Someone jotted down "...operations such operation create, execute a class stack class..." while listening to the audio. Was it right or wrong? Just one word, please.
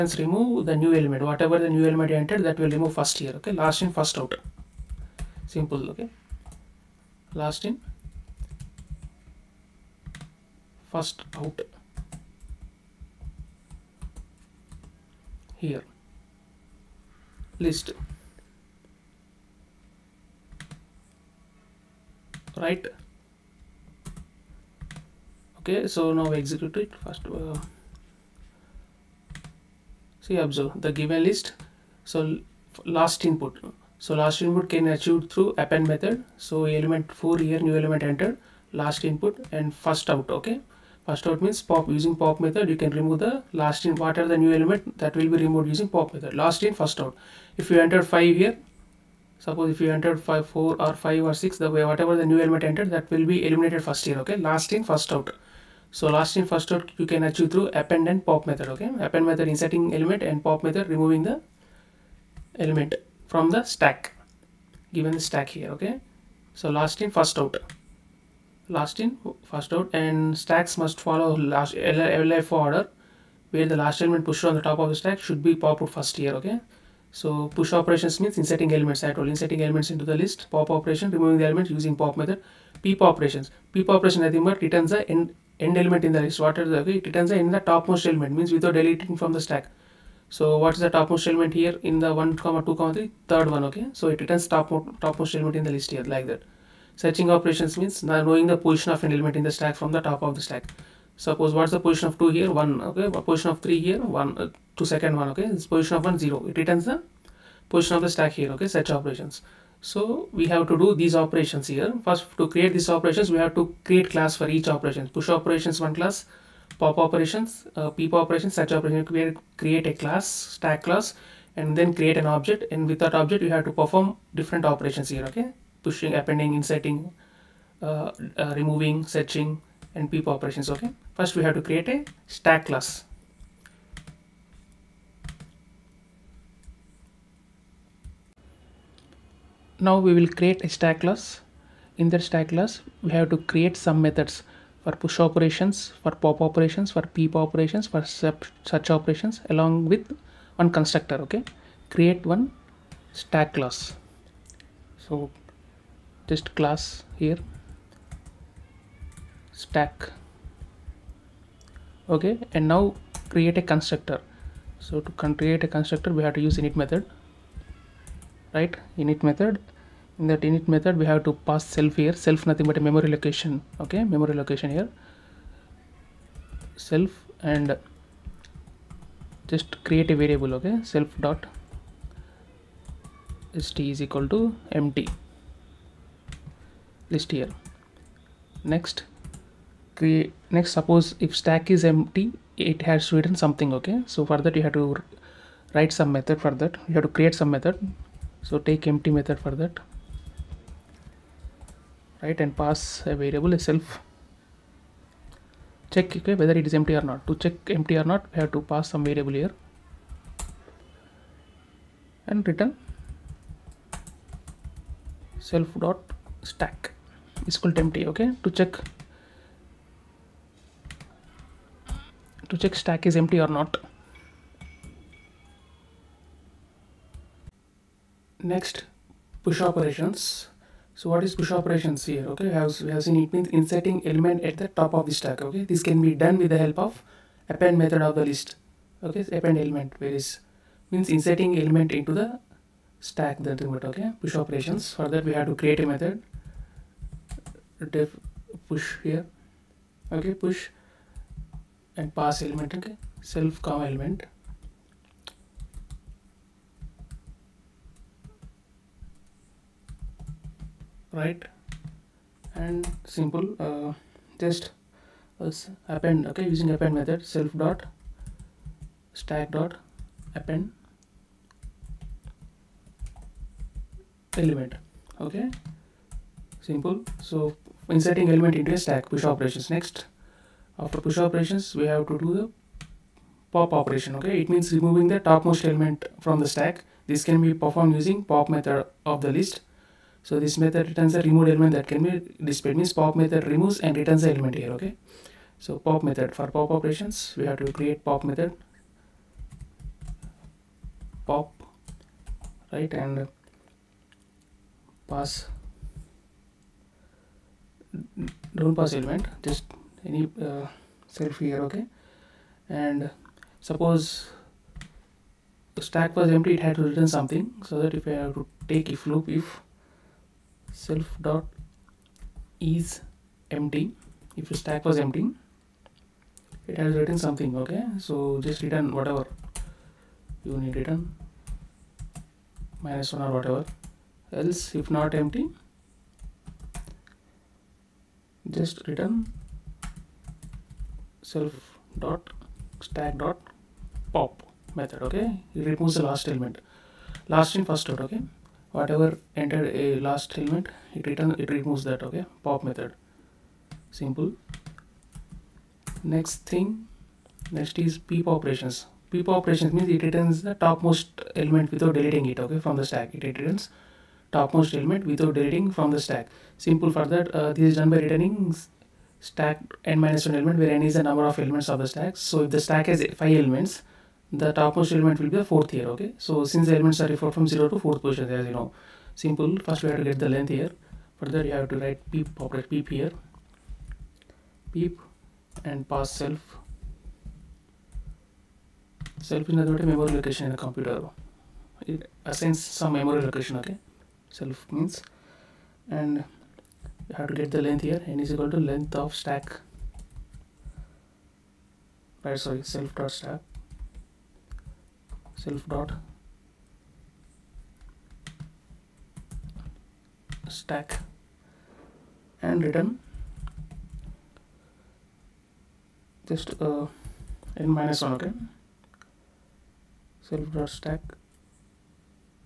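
wrong.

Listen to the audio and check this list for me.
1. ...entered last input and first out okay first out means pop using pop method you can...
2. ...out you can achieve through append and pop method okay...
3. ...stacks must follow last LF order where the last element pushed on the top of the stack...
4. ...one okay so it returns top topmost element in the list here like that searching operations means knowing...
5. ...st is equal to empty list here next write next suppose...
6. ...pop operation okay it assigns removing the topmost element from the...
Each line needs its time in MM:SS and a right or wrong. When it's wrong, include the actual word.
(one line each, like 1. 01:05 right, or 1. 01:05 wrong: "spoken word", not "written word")
1. 00:38 right
2. 00:56 right
3. 01:10 right
4. 01:33 right
5. 03:03 wrong: "create", not "write"
6. 04:43 wrong: "means", not "assigns".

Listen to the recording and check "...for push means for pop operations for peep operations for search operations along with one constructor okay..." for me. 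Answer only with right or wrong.
wrong.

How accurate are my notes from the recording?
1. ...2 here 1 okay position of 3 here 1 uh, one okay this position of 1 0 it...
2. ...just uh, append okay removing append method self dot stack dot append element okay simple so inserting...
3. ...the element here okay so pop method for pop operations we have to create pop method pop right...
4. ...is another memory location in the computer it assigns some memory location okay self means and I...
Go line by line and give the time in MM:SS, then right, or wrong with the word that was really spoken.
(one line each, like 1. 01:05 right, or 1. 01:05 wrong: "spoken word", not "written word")
1. 01:42 right
2. 04:24 wrong: "using", not "removing"
3. 04:54 right
4. 06:29 right.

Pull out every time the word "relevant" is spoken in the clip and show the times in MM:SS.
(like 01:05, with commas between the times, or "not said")
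not said.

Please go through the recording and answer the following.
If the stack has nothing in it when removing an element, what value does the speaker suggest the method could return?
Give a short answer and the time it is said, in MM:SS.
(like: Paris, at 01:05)
-1, at 05:32.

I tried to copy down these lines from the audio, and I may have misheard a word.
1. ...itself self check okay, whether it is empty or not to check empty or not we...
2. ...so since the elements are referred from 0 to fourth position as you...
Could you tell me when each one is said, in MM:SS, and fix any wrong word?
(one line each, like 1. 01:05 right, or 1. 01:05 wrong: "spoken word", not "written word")
1. 03:23 right
2. 06:16 right.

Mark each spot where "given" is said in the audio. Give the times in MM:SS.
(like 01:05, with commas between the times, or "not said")
00:31, 01:04.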